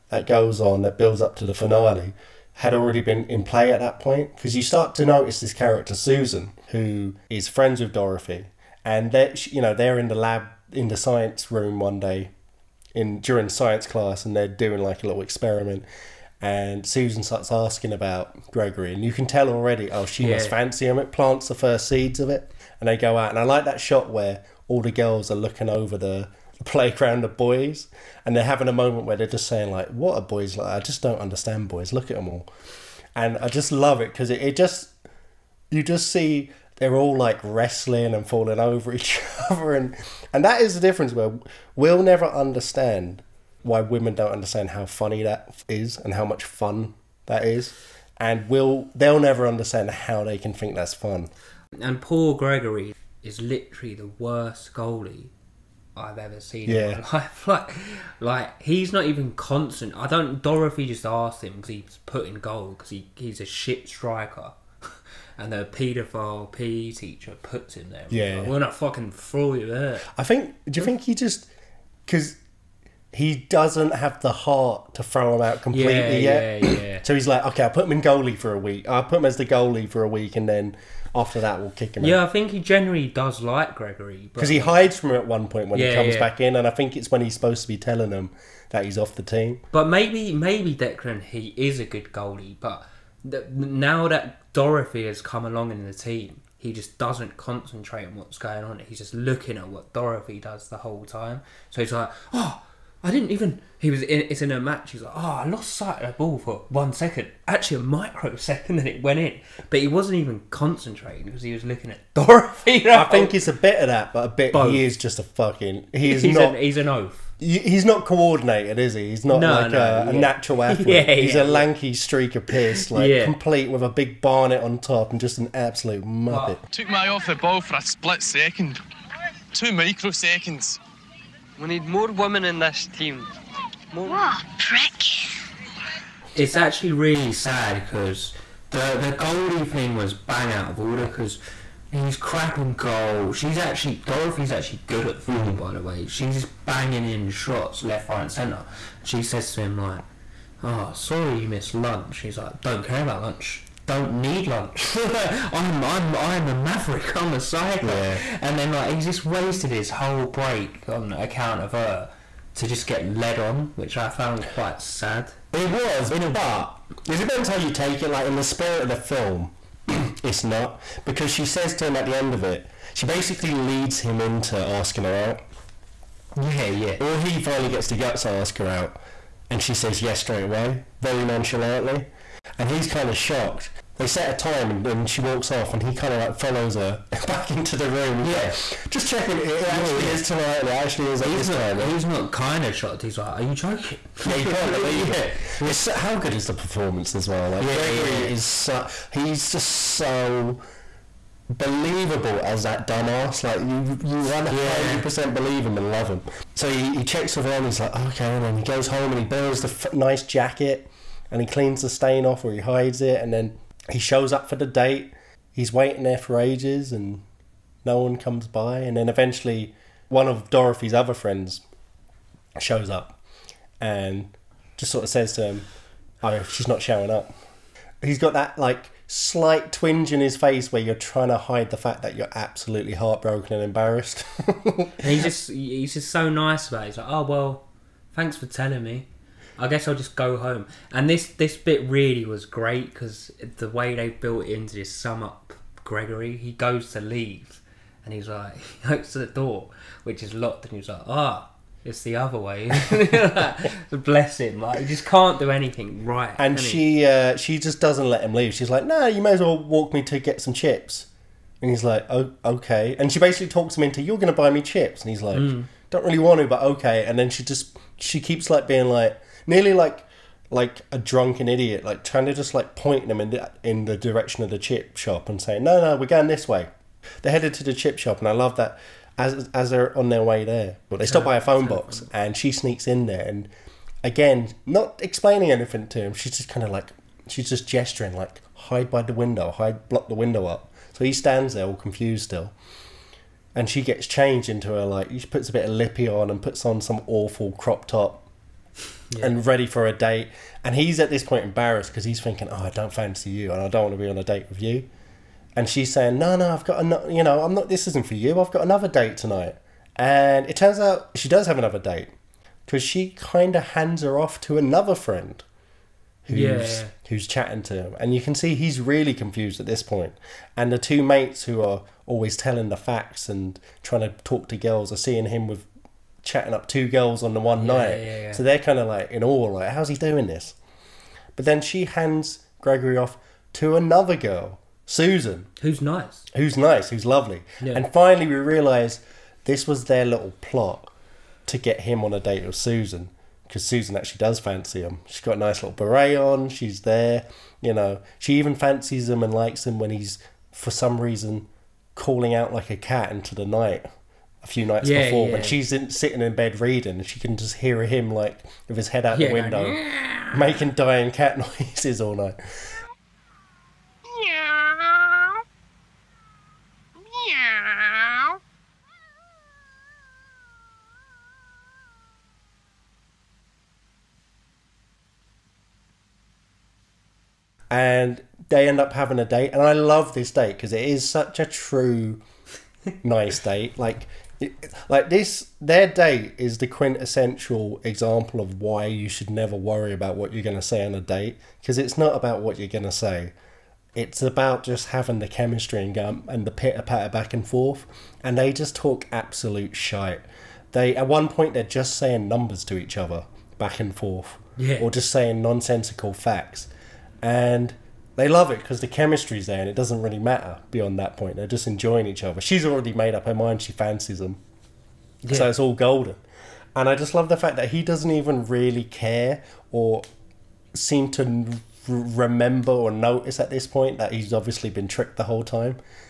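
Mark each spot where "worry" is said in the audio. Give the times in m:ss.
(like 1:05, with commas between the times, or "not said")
6:29.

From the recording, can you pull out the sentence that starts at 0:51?
And Paul Gregory is literally the worst goalie I've ever seen yeah.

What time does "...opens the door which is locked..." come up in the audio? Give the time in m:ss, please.
4:08.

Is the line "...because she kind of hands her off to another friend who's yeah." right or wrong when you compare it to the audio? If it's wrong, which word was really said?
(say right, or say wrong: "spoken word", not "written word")
right.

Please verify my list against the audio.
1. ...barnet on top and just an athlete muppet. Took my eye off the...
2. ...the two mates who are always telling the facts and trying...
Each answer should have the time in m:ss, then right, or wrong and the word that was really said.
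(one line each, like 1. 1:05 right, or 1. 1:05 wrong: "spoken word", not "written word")
1. 2:04 wrong: "absolute", not "athlete"
2. 5:20 right.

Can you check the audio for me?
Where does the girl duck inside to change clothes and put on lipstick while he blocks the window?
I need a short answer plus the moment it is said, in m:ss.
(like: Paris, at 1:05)
A phone box, at 4:41.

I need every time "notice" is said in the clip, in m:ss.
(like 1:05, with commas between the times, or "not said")
0:05, 7:02.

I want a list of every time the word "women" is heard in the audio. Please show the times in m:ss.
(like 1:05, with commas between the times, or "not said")
0:43, 2:12.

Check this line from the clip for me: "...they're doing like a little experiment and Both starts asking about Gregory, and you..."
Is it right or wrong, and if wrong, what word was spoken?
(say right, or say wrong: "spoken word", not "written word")
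wrong: "Susan", not "Both".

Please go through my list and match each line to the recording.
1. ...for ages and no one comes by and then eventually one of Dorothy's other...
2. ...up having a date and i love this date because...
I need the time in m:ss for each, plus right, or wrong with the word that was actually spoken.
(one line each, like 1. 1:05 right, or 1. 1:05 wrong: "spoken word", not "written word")
1. 3:36 right
2. 6:18 right.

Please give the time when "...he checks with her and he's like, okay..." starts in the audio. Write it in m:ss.
3:26.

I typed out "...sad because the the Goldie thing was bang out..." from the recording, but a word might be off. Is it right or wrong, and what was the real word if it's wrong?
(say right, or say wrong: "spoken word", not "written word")
right.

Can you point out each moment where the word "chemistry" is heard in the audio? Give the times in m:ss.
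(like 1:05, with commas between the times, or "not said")
6:35, 6:48.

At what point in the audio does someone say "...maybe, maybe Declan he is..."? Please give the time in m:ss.
1:29.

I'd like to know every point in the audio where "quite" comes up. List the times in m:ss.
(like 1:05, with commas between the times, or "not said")
2:44.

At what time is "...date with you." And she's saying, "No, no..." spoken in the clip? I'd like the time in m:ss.
5:04.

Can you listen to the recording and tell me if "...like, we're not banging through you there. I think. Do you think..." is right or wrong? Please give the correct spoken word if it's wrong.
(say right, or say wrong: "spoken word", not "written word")
wrong: "fucking", not "banging".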